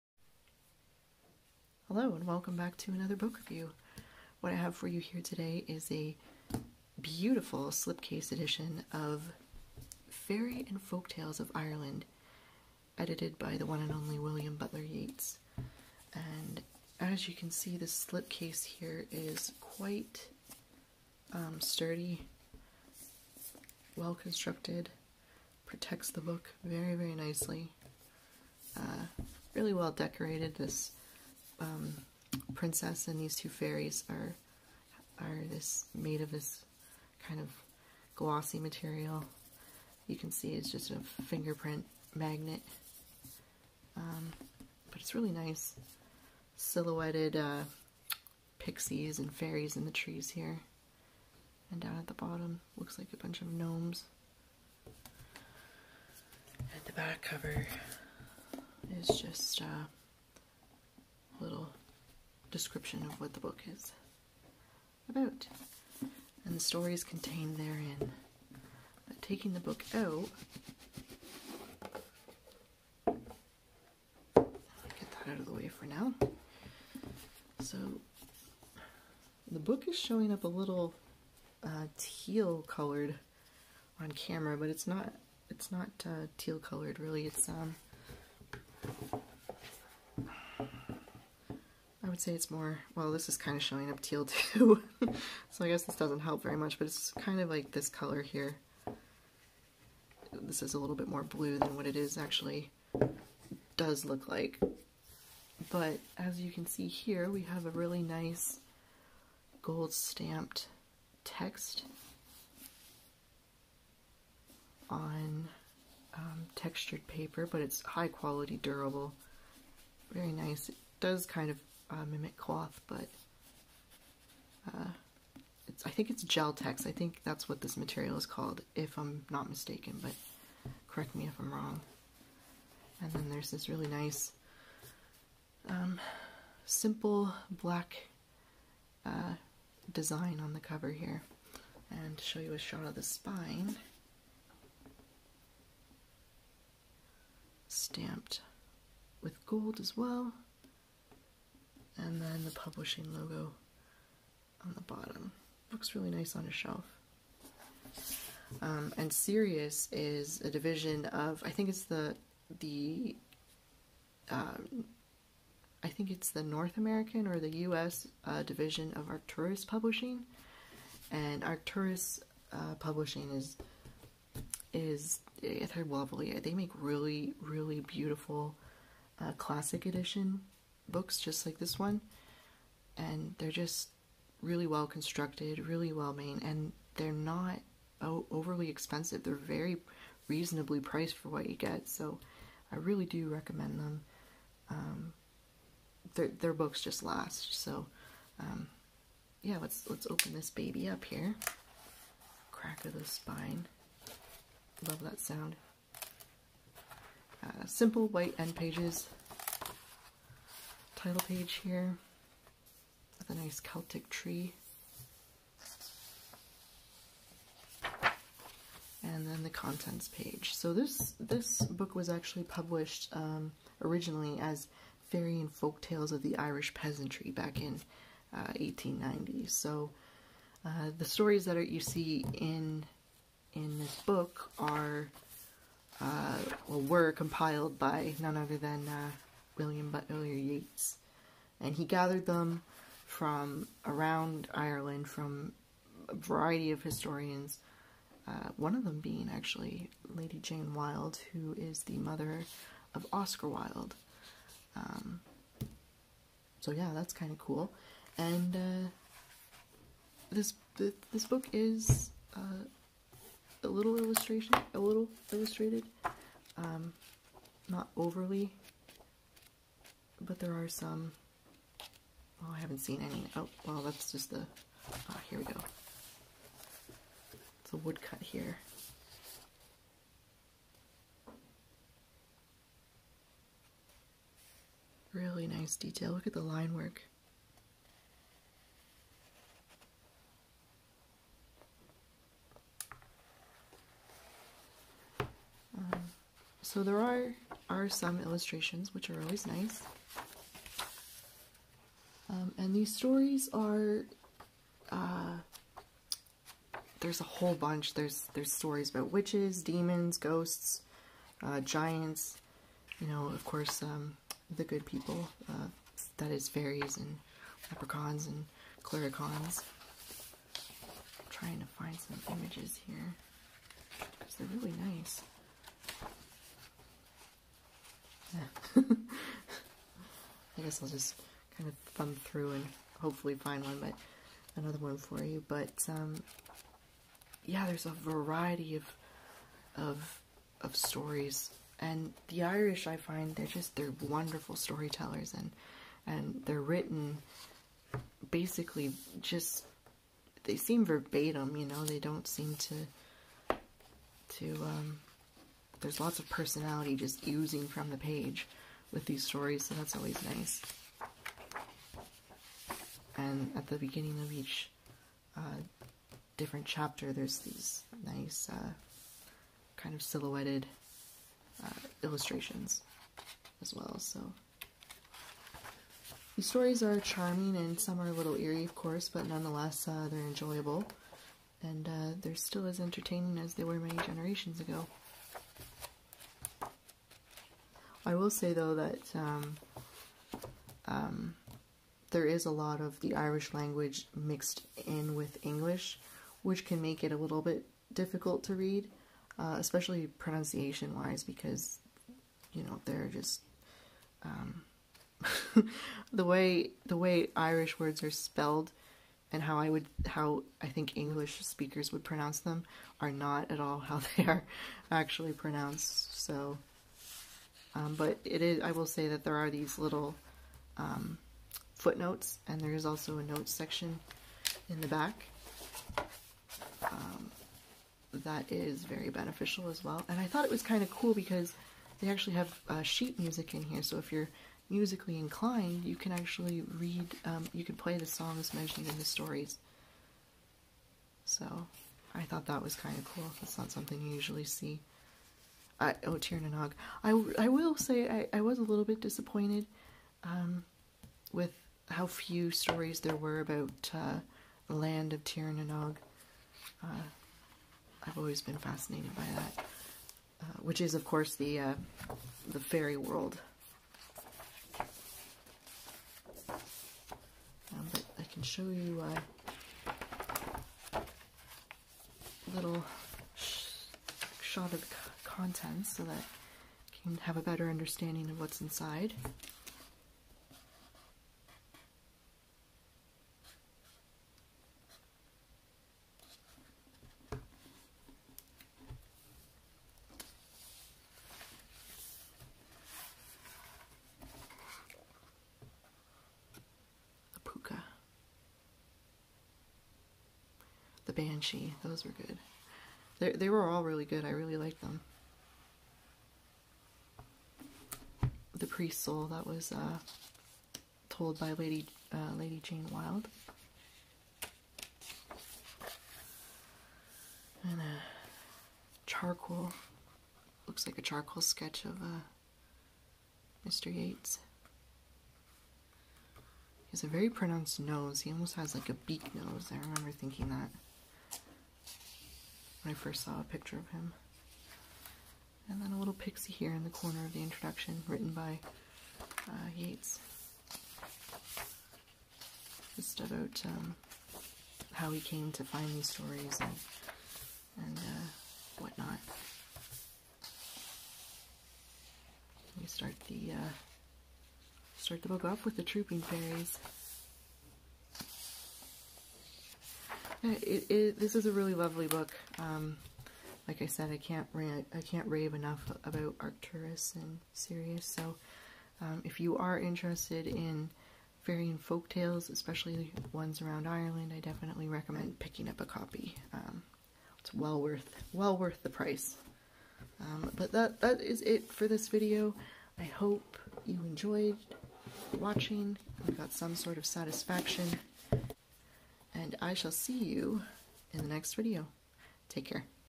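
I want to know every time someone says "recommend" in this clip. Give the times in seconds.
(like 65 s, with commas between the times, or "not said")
193 s, 574 s.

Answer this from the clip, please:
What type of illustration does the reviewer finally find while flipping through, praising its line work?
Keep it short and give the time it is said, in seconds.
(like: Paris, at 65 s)
A woodcut, at 277 s.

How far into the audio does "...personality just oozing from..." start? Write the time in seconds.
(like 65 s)
356 s.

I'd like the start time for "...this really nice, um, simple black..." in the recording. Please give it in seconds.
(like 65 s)
133 s.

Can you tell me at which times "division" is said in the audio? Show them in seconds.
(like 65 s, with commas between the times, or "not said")
160 s, 168 s.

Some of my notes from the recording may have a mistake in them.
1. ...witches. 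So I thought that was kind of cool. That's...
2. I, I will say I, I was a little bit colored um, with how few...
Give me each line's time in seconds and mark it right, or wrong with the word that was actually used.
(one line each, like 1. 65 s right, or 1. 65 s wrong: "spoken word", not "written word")
1. 439 s wrong: "stories", not "witches"
2. 447 s wrong: "disappointed", not "colored".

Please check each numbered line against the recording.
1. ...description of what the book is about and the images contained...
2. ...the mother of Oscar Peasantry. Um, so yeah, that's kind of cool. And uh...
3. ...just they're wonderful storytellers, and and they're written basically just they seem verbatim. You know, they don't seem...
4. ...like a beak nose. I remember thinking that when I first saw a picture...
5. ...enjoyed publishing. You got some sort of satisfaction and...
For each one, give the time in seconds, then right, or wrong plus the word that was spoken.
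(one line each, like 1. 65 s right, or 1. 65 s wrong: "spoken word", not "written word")
1. 62 s wrong: "stories", not "images"
2. 251 s wrong: "Wilde", not "Peasantry"
3. 343 s right
4. 528 s right
5. 584 s wrong: "watching", not "publishing".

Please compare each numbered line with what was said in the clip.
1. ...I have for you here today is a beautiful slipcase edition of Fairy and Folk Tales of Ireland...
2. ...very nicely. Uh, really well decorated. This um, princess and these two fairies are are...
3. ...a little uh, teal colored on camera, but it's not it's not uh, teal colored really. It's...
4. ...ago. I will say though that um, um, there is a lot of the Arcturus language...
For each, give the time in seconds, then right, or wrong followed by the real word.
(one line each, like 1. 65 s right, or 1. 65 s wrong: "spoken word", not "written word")
1. 4 s right
2. 26 s right
3. 80 s right
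4. 384 s wrong: "Irish", not "Arcturus".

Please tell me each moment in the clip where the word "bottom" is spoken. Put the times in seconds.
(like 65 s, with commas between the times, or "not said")
52 s, 154 s.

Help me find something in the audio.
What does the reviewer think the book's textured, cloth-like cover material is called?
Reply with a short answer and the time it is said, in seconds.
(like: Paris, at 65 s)
Geltex, at 126 s.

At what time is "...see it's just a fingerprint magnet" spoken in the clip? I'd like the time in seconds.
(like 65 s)
40 s.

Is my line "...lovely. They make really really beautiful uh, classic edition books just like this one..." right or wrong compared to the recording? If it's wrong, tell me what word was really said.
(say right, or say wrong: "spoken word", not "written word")
right.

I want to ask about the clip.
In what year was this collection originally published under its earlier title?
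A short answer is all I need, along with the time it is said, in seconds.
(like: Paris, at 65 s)
1890, at 228 s.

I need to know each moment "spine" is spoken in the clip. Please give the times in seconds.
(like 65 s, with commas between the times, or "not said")
143 s, 203 s.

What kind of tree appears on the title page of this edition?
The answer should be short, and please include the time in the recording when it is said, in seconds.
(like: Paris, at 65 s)
Celtic tree, at 213 s.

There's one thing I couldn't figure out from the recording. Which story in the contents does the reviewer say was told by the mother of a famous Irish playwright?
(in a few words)
The Priest Soul.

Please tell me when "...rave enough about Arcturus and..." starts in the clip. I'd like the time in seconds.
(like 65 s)
565 s.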